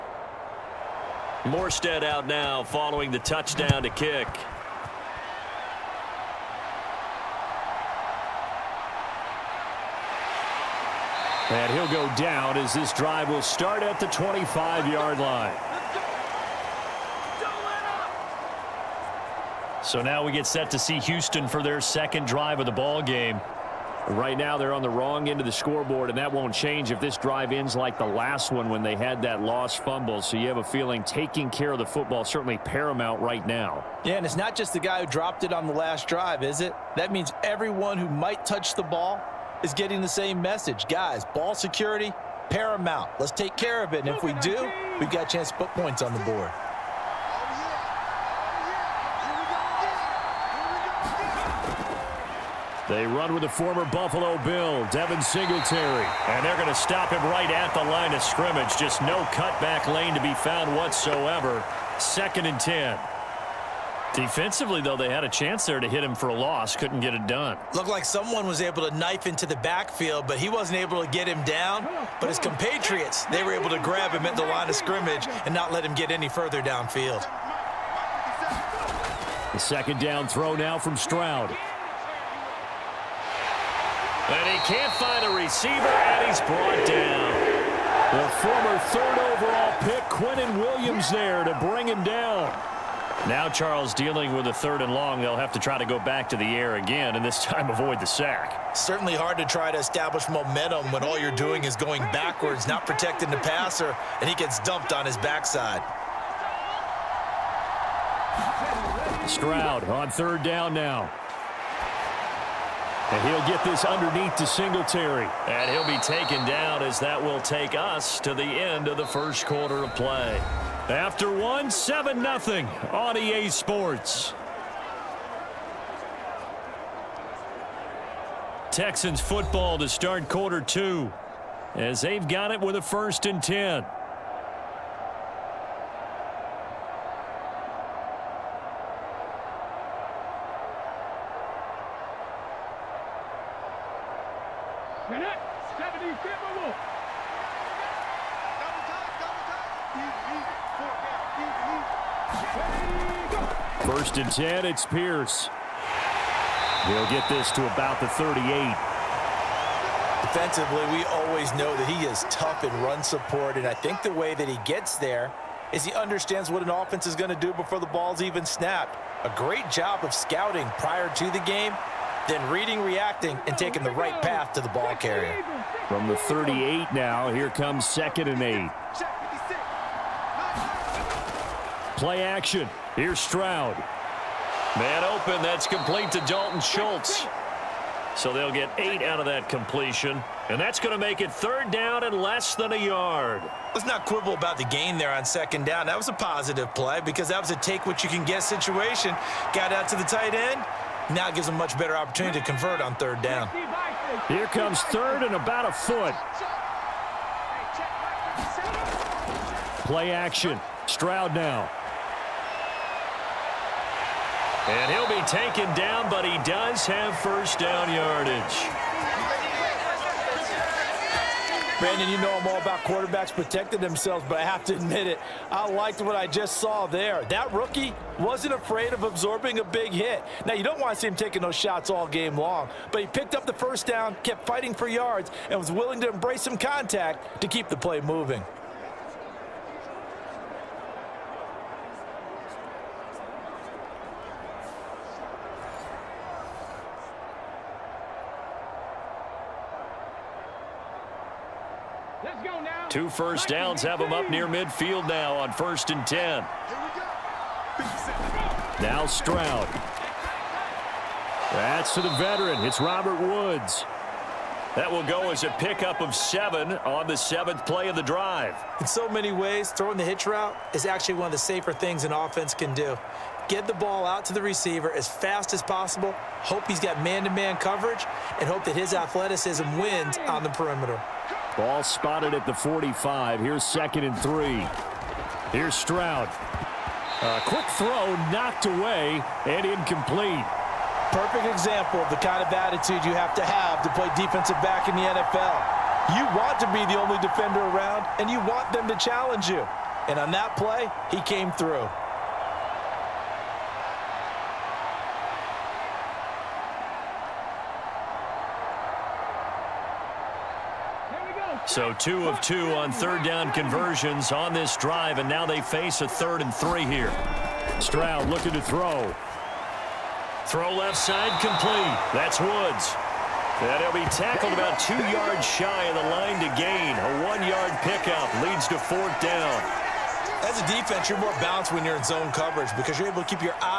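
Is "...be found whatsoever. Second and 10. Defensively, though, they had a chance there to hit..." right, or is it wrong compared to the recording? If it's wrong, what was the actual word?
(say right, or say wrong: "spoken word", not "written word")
right.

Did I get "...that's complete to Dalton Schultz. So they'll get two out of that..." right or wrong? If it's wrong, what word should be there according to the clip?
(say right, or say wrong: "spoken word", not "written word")
wrong: "eight", not "two".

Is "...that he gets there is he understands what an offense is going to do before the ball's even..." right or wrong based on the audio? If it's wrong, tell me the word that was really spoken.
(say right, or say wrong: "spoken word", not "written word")
right.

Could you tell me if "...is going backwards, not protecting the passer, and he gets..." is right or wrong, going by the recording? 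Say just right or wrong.
right.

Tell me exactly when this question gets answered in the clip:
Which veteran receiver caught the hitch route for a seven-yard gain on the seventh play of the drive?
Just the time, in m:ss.
4:22.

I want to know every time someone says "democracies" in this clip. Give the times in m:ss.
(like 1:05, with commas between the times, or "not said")
not said.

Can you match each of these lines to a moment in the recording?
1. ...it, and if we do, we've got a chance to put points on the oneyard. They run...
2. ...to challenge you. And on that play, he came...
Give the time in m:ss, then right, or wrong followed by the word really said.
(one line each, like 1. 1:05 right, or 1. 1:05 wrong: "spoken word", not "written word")
1. 0:43 wrong: "board", not "oneyard"
2. 4:58 right.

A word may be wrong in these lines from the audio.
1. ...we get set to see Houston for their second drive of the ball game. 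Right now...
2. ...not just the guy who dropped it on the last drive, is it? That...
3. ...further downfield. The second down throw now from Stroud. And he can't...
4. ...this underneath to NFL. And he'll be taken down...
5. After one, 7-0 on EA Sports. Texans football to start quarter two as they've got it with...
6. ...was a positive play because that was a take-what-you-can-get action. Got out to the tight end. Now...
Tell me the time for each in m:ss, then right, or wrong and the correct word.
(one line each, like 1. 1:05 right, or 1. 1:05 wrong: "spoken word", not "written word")
1. 0:20 right
2. 0:34 right
3. 1:16 right
4. 1:53 wrong: "Singletary", not "NFL"
5. 2:00 right
6. 3:15 wrong: "situation", not "action".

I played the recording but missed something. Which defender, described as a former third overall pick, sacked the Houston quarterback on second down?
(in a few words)
Quinnen Williams.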